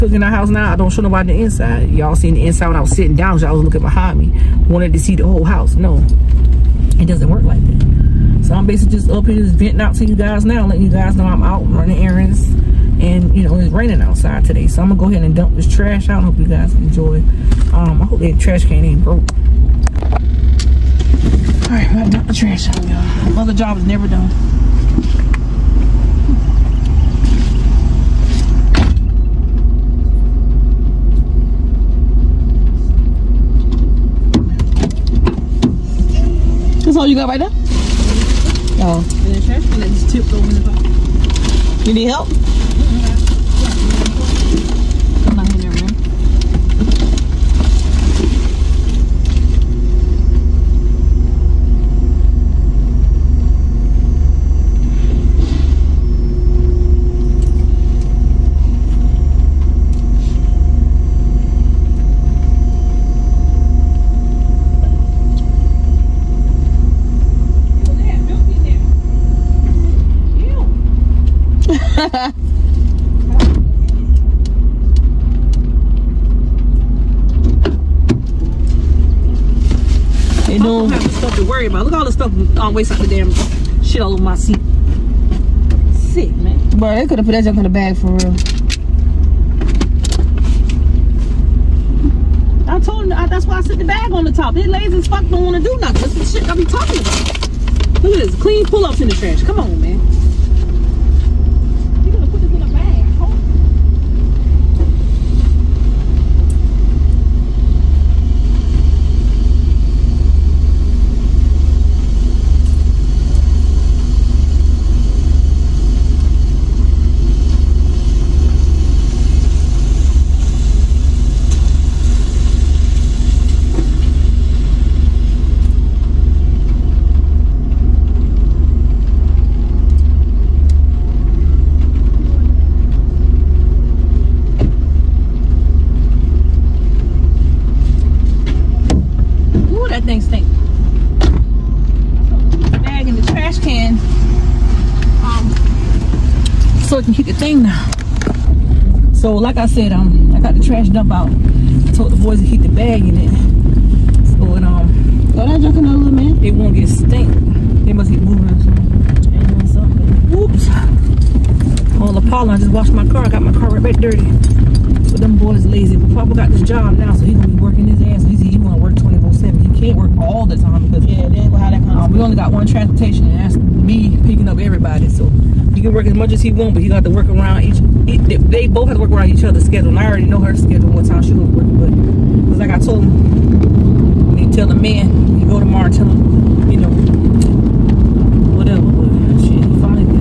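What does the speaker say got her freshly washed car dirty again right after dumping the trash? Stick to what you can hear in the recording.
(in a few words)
Pollen.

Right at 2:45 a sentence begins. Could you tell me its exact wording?
But Papa got this job now, so he's gonna be working his ass.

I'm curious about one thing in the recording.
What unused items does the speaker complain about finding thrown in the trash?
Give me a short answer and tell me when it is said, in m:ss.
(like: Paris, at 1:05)
Clean pull-ups, at 1:38.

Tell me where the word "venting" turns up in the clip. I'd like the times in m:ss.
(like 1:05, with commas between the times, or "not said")
0:09.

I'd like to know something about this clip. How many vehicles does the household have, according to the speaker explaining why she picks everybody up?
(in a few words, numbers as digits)
1.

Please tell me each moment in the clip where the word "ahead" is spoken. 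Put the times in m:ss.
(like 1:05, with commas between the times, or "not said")
0:15.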